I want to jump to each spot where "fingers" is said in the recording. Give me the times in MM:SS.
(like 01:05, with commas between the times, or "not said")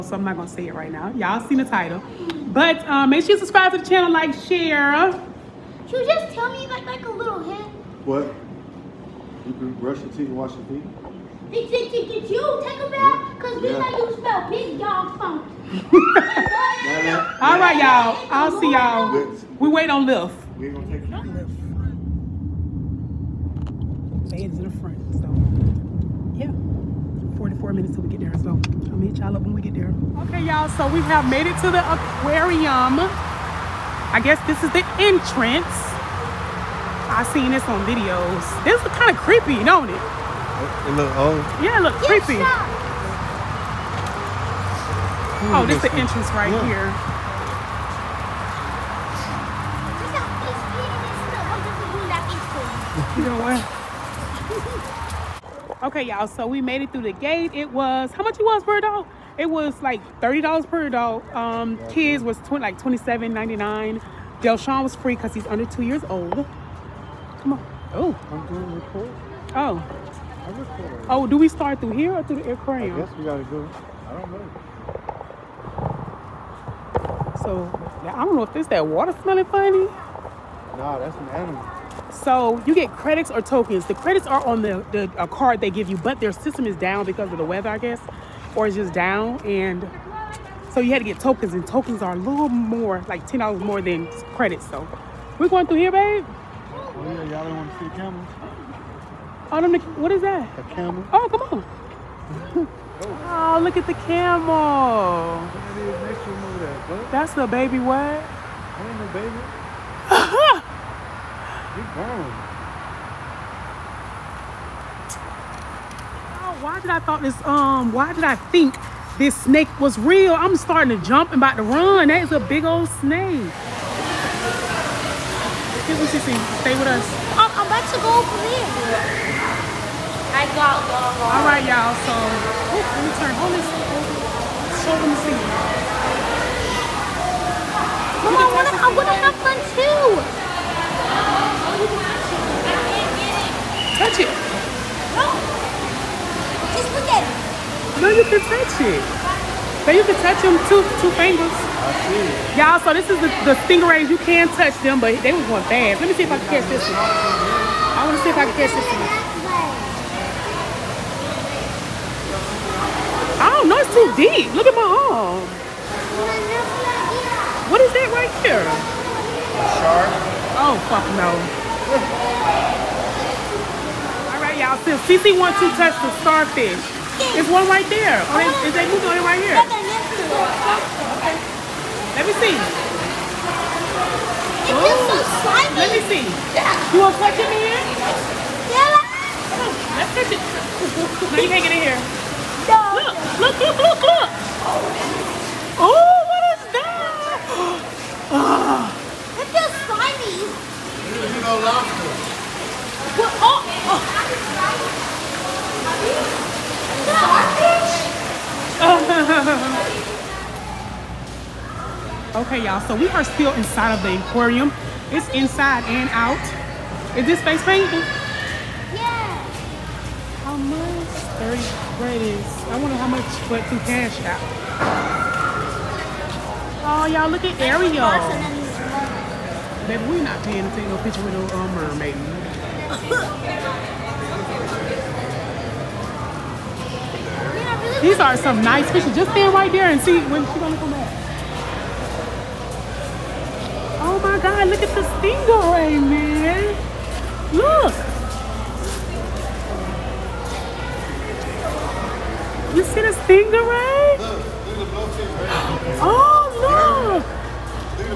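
02:31.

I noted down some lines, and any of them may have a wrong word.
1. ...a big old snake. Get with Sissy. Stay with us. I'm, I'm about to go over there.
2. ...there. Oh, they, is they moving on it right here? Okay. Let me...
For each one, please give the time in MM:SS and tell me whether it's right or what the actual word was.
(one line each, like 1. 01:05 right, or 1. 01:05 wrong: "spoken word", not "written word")
1. 02:02 right
2. 02:57 right.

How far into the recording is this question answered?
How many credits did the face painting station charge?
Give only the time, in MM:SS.
03:41.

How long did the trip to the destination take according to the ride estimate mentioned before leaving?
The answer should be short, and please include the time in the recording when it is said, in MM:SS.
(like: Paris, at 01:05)
44 minutes, at 00:27.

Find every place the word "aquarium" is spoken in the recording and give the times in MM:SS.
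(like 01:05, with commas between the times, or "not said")
00:31, 01:12, 03:34.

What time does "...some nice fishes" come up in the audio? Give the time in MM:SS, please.
03:58.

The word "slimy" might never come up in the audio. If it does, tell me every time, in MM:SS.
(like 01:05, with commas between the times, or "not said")
03:05, 03:19.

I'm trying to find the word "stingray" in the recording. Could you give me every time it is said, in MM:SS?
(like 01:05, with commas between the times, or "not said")
02:33, 04:05, 04:13.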